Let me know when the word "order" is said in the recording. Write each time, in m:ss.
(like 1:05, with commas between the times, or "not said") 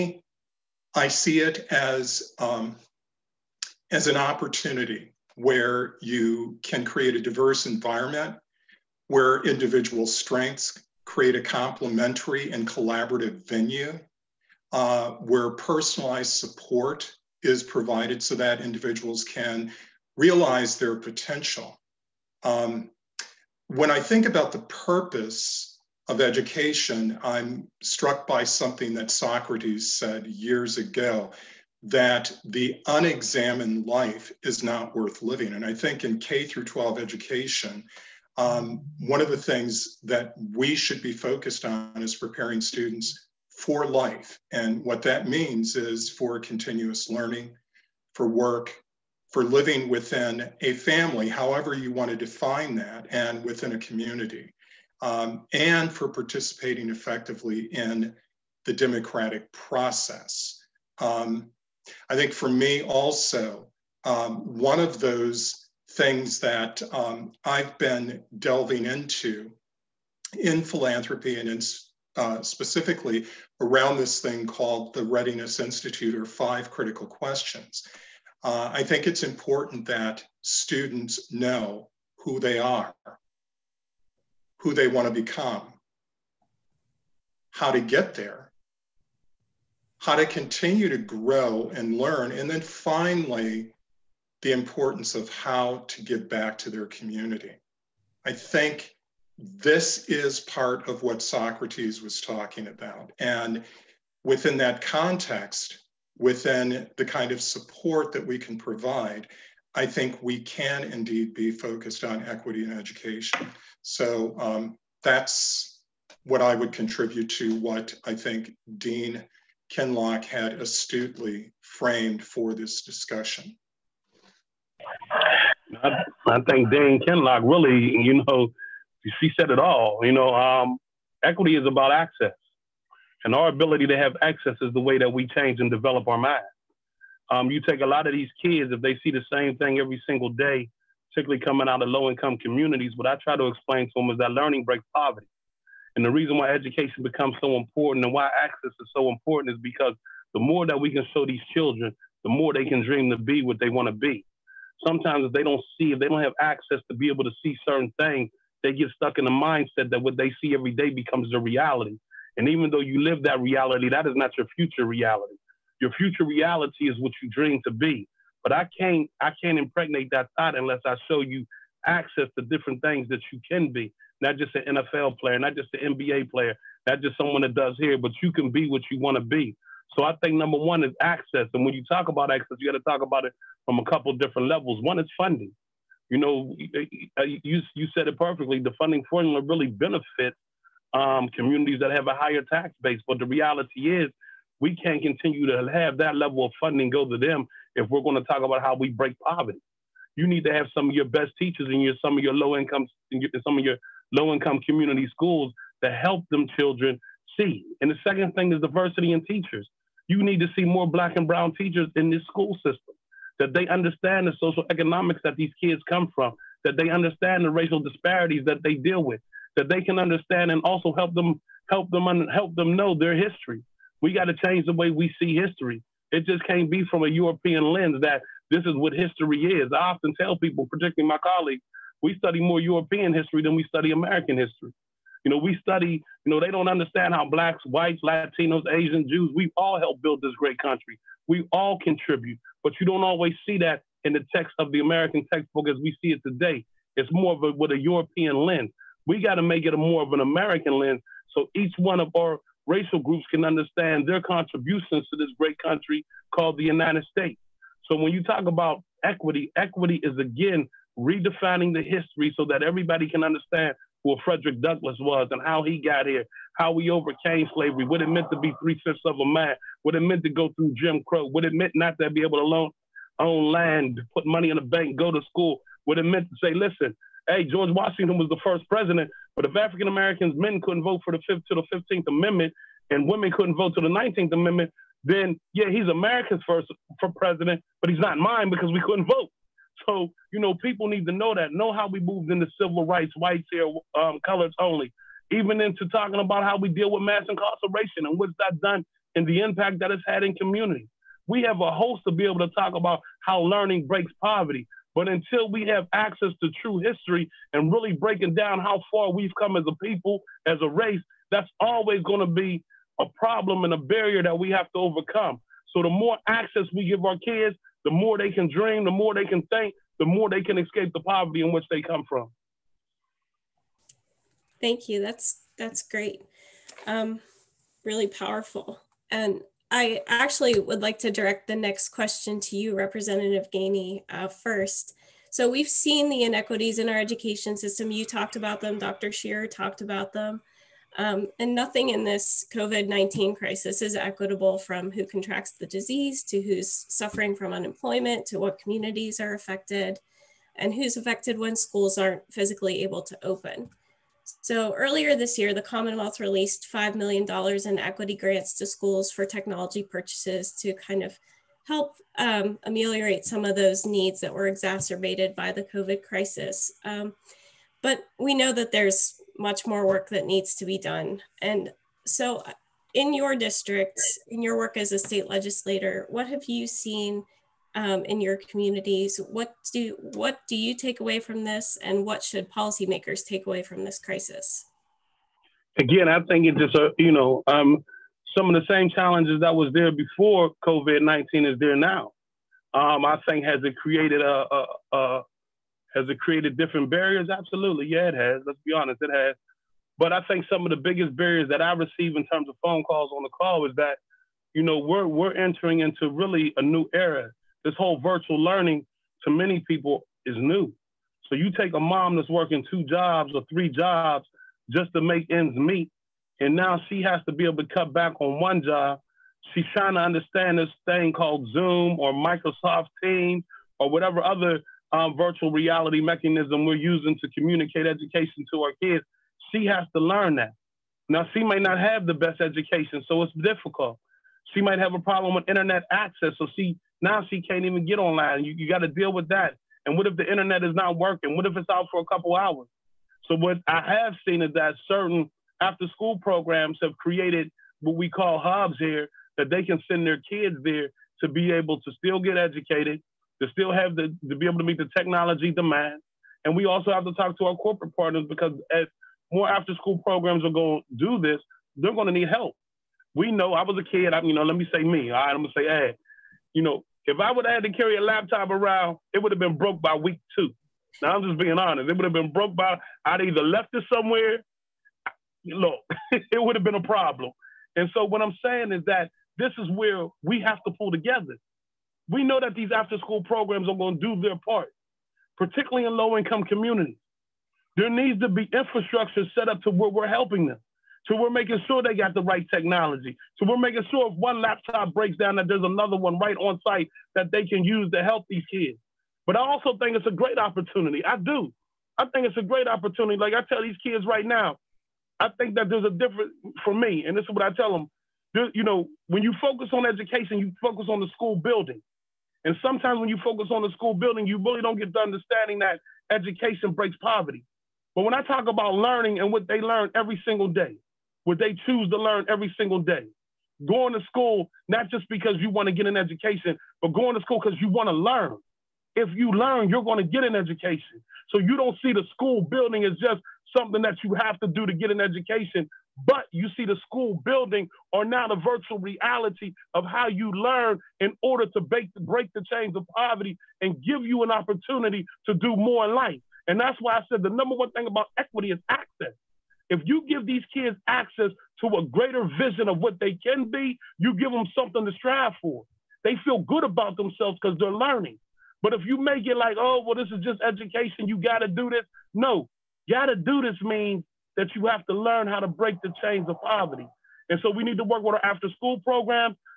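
9:01.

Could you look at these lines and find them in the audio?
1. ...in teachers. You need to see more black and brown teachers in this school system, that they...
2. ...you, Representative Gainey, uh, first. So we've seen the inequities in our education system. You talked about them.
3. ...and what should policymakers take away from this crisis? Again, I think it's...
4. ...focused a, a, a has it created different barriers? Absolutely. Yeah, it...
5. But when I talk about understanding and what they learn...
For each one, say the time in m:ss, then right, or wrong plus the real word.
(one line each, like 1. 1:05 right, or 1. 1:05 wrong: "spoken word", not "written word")
1. 3:29 right
2. 5:32 right
3. 6:21 right
4. 6:33 wrong: "created", not "focused"
5. 8:37 wrong: "learning", not "understanding".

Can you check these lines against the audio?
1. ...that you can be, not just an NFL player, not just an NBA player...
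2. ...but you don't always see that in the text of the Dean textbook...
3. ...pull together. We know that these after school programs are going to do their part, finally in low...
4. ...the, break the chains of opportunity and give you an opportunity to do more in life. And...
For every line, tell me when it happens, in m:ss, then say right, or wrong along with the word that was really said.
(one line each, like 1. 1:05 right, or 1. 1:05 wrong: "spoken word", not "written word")
1. 2:53 right
2. 4:02 wrong: "American", not "Dean"
3. 8:00 wrong: "particularly", not "finally"
4. 9:01 wrong: "poverty", not "opportunity".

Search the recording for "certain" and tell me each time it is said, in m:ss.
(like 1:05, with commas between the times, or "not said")
2:37, 7:24.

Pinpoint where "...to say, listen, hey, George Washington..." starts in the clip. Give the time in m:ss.
4:36.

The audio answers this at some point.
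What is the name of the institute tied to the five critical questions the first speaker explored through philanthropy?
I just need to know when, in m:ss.
1:15.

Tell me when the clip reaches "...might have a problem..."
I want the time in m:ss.
7:14.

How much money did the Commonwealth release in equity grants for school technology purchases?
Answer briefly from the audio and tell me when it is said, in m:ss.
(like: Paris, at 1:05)
$5 million, at 5:56.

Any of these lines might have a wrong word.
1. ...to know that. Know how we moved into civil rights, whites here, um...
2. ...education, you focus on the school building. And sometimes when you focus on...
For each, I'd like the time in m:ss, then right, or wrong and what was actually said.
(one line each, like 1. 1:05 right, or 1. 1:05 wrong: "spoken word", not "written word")
1. 4:51 right
2. 8:29 right.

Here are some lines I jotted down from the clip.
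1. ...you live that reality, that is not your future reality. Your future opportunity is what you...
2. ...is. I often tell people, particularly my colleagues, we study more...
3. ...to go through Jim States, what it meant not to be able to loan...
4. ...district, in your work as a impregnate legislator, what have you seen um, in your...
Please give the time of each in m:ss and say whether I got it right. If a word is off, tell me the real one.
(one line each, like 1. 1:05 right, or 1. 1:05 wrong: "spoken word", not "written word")
1. 2:42 wrong: "reality", not "opportunity"
2. 3:49 right
3. 4:30 wrong: "Crow", not "States"
4. 6:13 wrong: "state", not "impregnate".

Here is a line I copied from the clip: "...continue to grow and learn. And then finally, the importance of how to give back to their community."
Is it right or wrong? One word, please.
right.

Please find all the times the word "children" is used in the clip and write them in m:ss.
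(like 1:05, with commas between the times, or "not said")
2:31, 3:26.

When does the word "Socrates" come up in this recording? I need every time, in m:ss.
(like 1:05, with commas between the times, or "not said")
0:29, 1:41.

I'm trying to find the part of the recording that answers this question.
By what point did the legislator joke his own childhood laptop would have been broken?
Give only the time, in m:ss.
7:49.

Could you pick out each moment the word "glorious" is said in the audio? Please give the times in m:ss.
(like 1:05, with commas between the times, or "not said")
not said.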